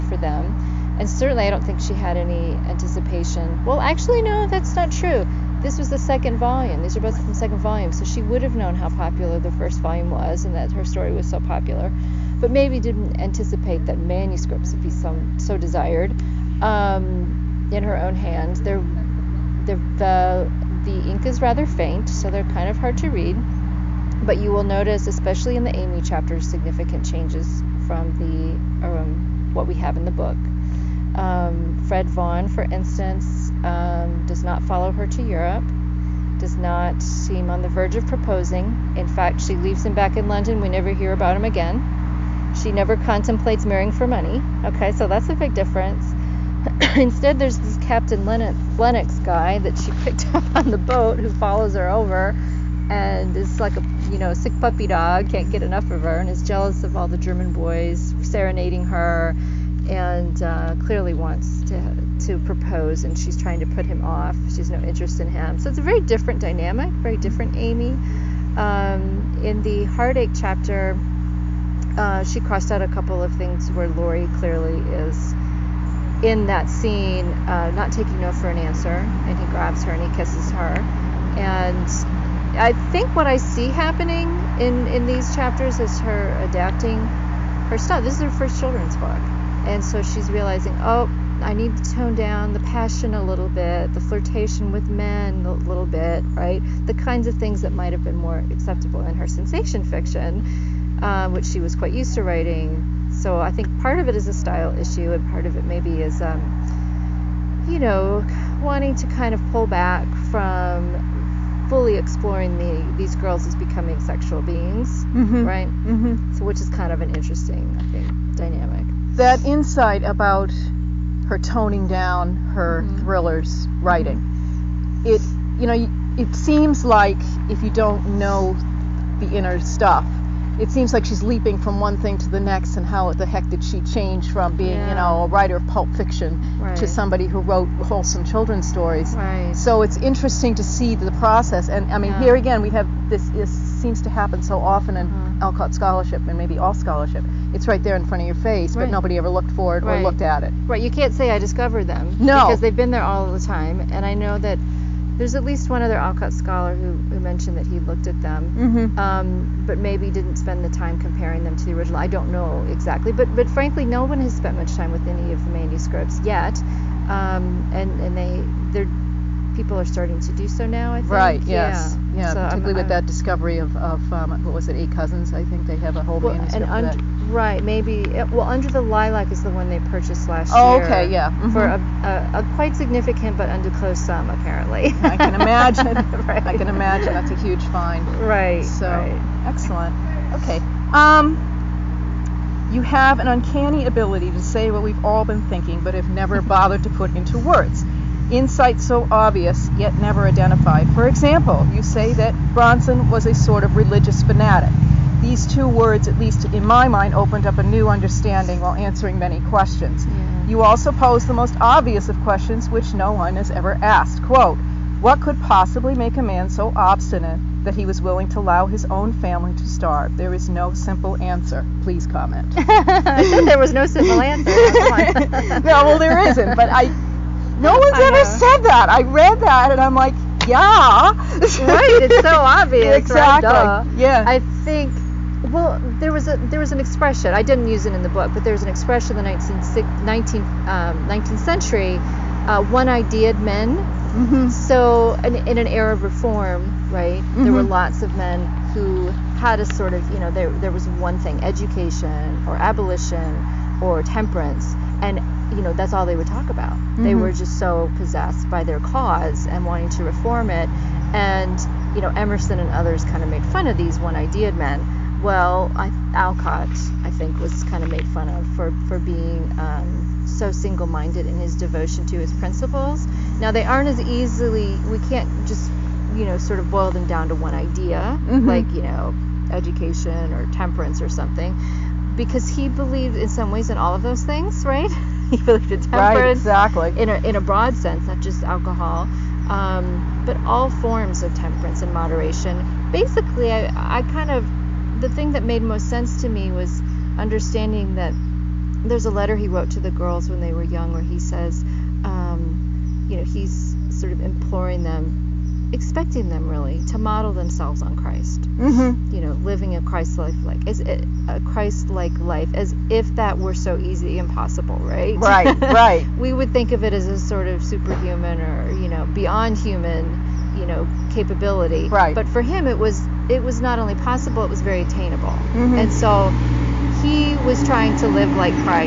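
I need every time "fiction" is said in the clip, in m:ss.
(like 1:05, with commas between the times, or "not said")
1:39, 2:15.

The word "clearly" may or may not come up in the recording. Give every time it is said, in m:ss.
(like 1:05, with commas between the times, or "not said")
1:00, 1:14.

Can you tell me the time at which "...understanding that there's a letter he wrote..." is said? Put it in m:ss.
4:57.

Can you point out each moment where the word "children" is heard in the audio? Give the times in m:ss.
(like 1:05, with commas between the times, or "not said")
1:28, 2:18.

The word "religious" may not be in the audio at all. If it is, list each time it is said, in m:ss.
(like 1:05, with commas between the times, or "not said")
3:23.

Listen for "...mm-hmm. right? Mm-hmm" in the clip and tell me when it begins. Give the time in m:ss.
1:55.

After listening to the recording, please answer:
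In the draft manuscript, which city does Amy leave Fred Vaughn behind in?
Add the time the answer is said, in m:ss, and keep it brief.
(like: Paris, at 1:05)
London, at 0:40.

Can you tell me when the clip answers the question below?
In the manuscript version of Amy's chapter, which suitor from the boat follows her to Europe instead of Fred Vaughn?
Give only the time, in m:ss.
0:47.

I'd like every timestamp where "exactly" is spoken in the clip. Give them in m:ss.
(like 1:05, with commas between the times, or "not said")
2:42, 3:52, 4:46.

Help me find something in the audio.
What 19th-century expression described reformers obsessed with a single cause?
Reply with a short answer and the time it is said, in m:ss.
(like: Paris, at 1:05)
one ideaed men, at 4:02.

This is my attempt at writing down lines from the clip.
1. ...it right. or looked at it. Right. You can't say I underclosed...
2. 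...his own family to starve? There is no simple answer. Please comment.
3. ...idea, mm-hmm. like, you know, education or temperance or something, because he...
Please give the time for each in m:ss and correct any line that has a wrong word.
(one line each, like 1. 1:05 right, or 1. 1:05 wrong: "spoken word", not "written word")
1. 2:29 wrong: "discovered", not "underclosed"
2. 3:38 right
3. 4:37 right.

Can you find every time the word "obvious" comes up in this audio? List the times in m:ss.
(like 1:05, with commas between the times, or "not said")
3:19, 3:31, 3:52.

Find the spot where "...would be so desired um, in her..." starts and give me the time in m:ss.
0:14.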